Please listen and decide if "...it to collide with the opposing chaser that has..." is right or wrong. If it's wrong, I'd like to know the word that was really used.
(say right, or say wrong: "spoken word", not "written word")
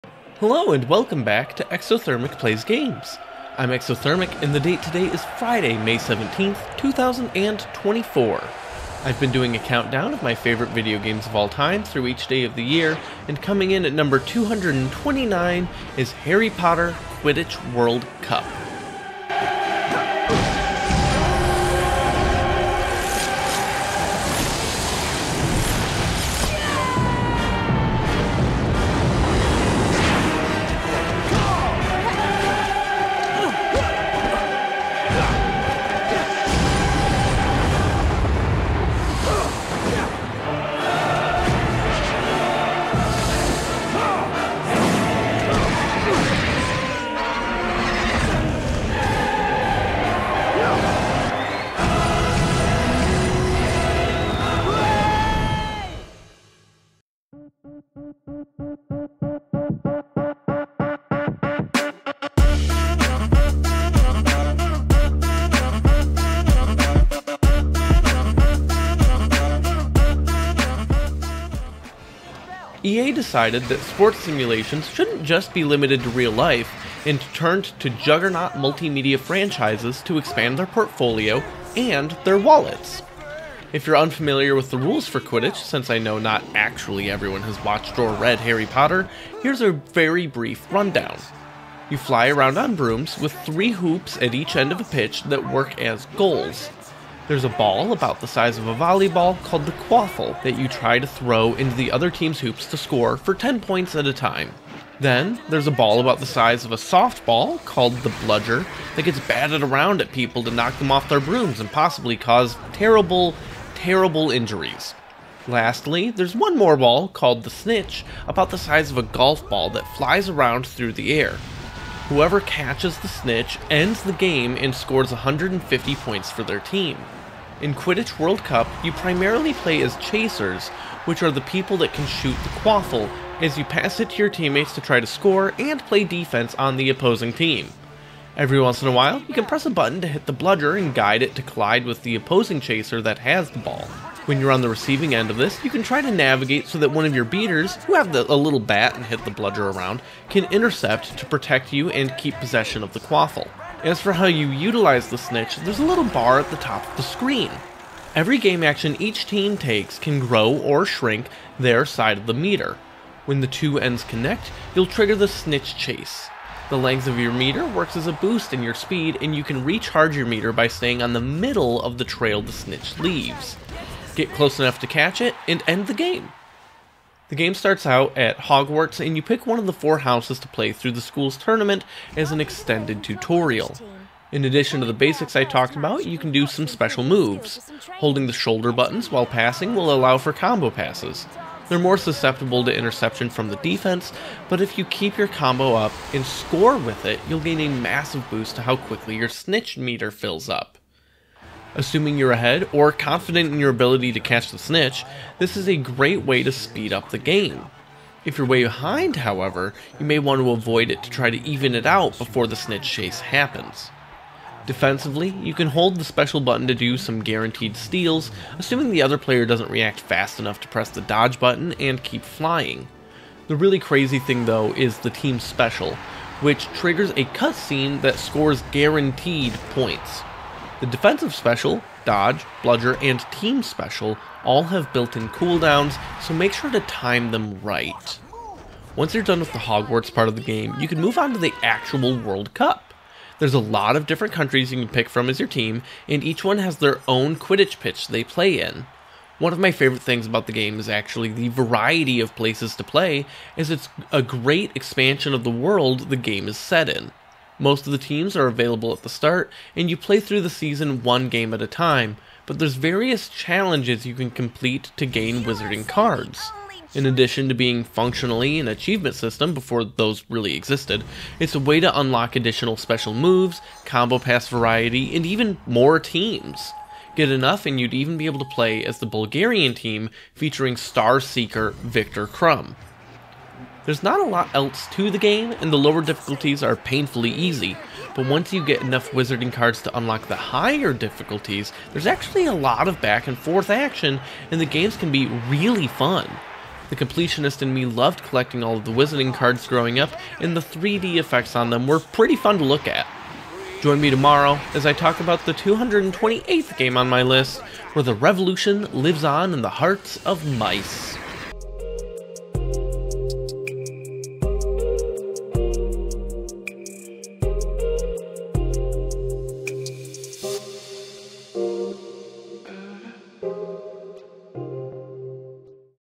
right.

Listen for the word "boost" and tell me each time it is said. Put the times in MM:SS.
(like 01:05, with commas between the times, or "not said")
02:48, 03:18.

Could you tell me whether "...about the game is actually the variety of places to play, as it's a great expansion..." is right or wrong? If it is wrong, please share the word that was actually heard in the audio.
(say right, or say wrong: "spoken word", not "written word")
right.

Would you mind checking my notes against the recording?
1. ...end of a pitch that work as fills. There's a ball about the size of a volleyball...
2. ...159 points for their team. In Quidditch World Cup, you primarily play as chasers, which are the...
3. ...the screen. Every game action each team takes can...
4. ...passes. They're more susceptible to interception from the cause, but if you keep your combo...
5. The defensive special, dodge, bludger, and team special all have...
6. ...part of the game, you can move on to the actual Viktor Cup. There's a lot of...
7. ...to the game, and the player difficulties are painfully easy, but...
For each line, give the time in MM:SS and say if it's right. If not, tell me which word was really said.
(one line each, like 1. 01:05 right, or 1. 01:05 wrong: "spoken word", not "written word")
1. 01:34 wrong: "goals", not "fills"
2. 02:05 wrong: "150", not "159"
3. 02:36 right
4. 03:10 wrong: "defense", not "cause"
5. 03:50 right
6. 04:00 wrong: "World", not "Viktor"
7. 04:44 wrong: "lower", not "player".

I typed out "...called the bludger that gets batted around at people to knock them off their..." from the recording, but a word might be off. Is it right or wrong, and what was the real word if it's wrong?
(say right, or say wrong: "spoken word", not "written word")
right.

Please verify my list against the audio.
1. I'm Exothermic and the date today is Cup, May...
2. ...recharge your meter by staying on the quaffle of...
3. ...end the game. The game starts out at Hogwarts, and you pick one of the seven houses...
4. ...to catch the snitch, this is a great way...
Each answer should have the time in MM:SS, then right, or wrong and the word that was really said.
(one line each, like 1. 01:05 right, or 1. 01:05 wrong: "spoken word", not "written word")
1. 00:03 wrong: "Friday", not "Cup"
2. 02:49 wrong: "middle", not "quaffle"
3. 02:55 wrong: "four", not "seven"
4. 03:24 right.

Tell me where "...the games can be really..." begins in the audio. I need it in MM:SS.
04:54.